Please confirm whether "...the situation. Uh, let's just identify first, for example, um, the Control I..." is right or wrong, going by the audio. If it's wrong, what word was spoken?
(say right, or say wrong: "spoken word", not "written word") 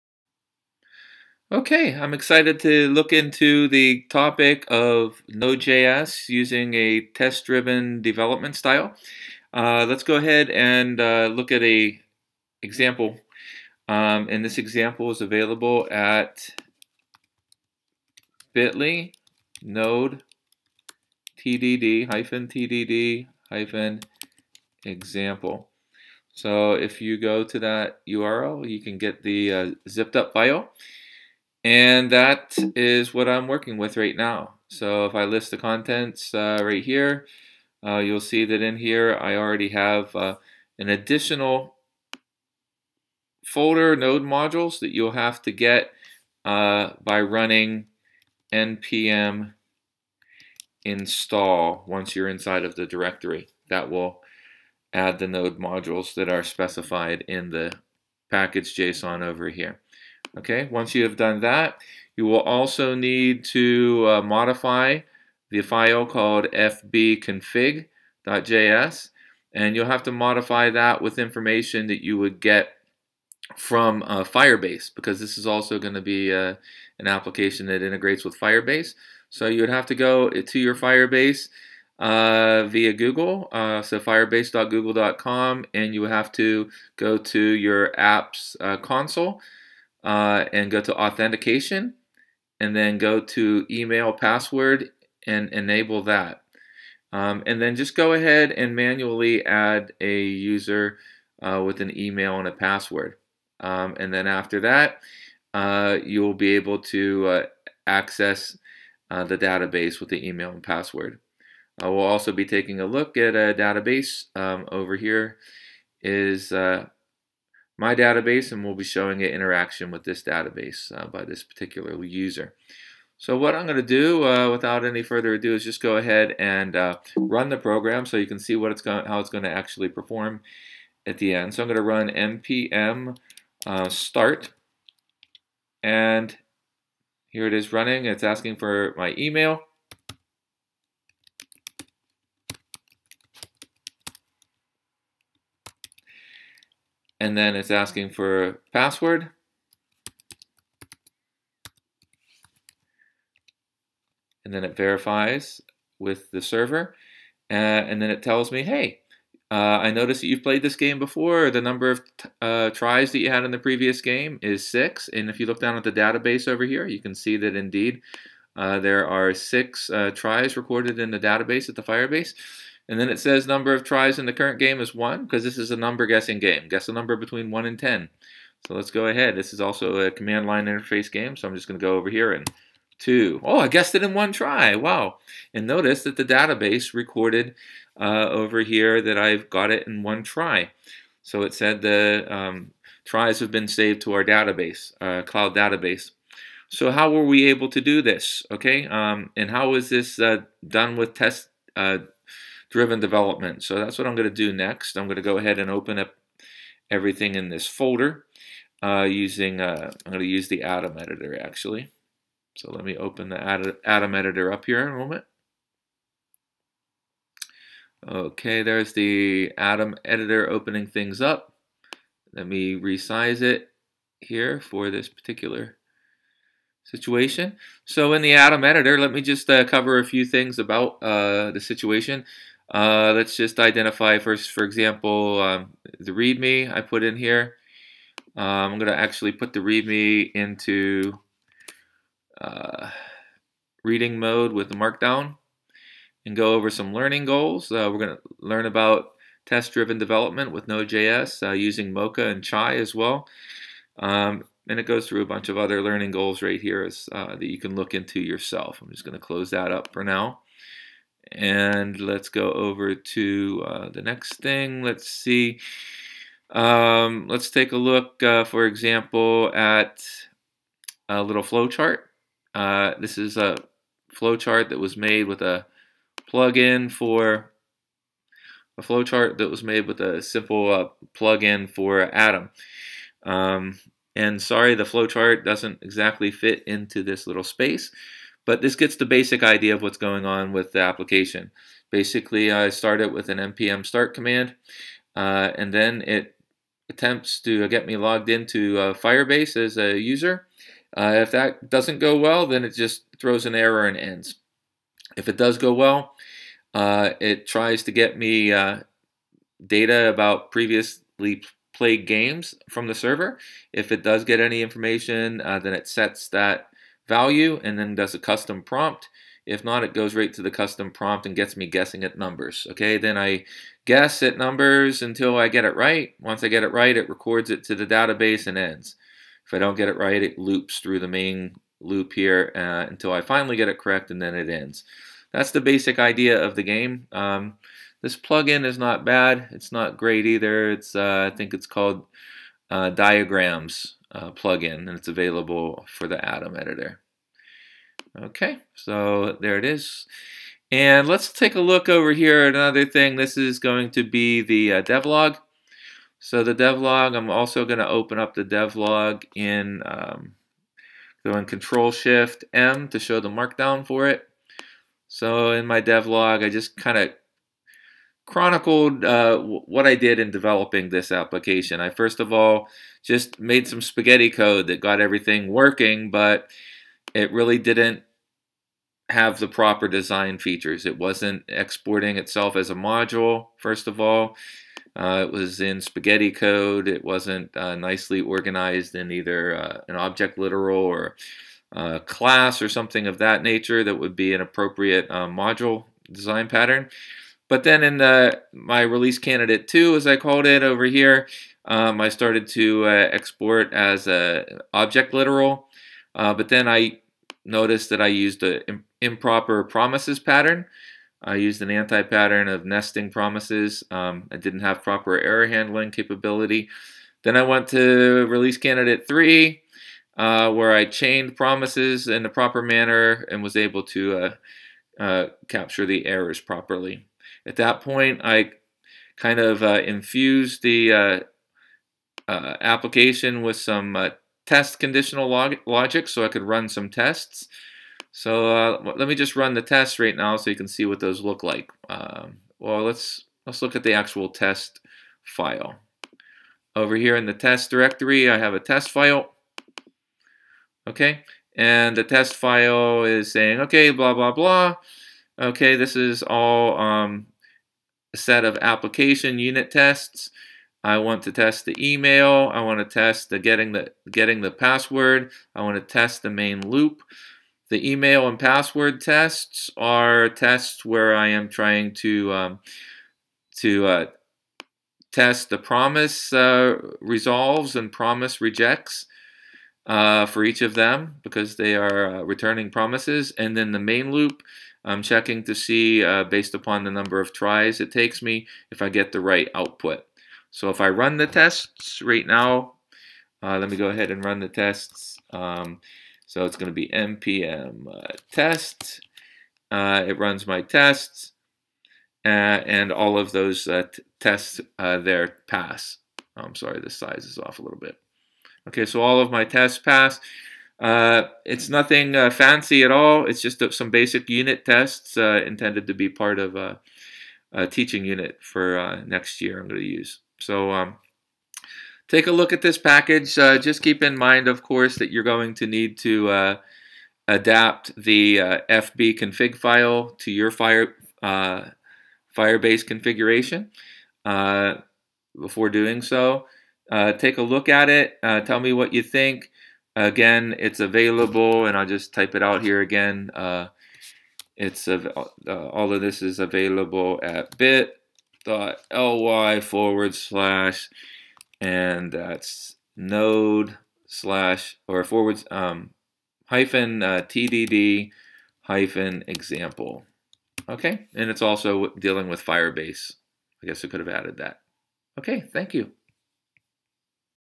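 wrong: "README", not "Control".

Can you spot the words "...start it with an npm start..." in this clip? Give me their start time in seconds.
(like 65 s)
292 s.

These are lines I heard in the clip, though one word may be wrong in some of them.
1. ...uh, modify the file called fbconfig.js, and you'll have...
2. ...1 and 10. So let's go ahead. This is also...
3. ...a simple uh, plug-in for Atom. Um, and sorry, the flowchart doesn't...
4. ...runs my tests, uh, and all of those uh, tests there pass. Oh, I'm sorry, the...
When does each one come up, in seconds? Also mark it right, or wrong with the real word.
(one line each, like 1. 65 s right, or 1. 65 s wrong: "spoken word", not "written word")
1. 64 s right
2. 177 s right
3. 280 s right
4. 500 s right.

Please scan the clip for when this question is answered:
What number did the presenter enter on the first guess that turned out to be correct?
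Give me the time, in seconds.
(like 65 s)
182 s.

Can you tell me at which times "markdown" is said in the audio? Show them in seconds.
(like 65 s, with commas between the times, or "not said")
244 s, 363 s.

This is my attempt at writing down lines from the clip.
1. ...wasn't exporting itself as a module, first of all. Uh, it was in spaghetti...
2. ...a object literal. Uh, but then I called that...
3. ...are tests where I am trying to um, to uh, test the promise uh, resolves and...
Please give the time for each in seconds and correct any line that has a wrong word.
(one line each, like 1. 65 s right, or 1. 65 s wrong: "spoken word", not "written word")
1. 380 s right
2. 404 s wrong: "noticed", not "called"
3. 469 s right.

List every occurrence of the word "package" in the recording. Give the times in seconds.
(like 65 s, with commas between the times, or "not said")
58 s, 522 s.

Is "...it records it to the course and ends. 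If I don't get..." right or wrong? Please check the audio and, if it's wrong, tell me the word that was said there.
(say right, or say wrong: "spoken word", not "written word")
wrong: "database", not "course".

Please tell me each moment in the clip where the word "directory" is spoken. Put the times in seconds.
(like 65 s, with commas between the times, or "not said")
52 s, 447 s.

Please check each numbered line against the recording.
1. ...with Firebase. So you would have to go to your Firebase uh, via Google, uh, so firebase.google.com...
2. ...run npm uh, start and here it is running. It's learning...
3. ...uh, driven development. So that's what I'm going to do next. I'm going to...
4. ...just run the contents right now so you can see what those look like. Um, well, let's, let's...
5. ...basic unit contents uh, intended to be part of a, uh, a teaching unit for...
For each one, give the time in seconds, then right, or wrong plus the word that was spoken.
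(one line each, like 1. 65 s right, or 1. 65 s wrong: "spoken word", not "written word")
1. 78 s right
2. 131 s wrong: "asking", not "learning"
3. 201 s right
4. 439 s wrong: "tests", not "contents"
5. 513 s wrong: "tests", not "contents".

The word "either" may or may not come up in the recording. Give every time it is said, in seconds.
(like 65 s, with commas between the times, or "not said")
340 s, 389 s.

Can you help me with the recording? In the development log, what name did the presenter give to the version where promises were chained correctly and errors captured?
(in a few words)
release candidate three.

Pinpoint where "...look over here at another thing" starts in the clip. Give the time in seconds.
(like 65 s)
351 s.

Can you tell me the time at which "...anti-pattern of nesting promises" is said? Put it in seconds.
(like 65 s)
411 s.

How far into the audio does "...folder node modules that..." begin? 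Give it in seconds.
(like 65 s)
43 s.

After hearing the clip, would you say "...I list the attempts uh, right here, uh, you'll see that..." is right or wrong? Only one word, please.
wrong.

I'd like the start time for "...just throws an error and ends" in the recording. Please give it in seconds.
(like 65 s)
302 s.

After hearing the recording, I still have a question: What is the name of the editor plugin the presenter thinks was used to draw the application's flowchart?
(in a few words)
Diagrams.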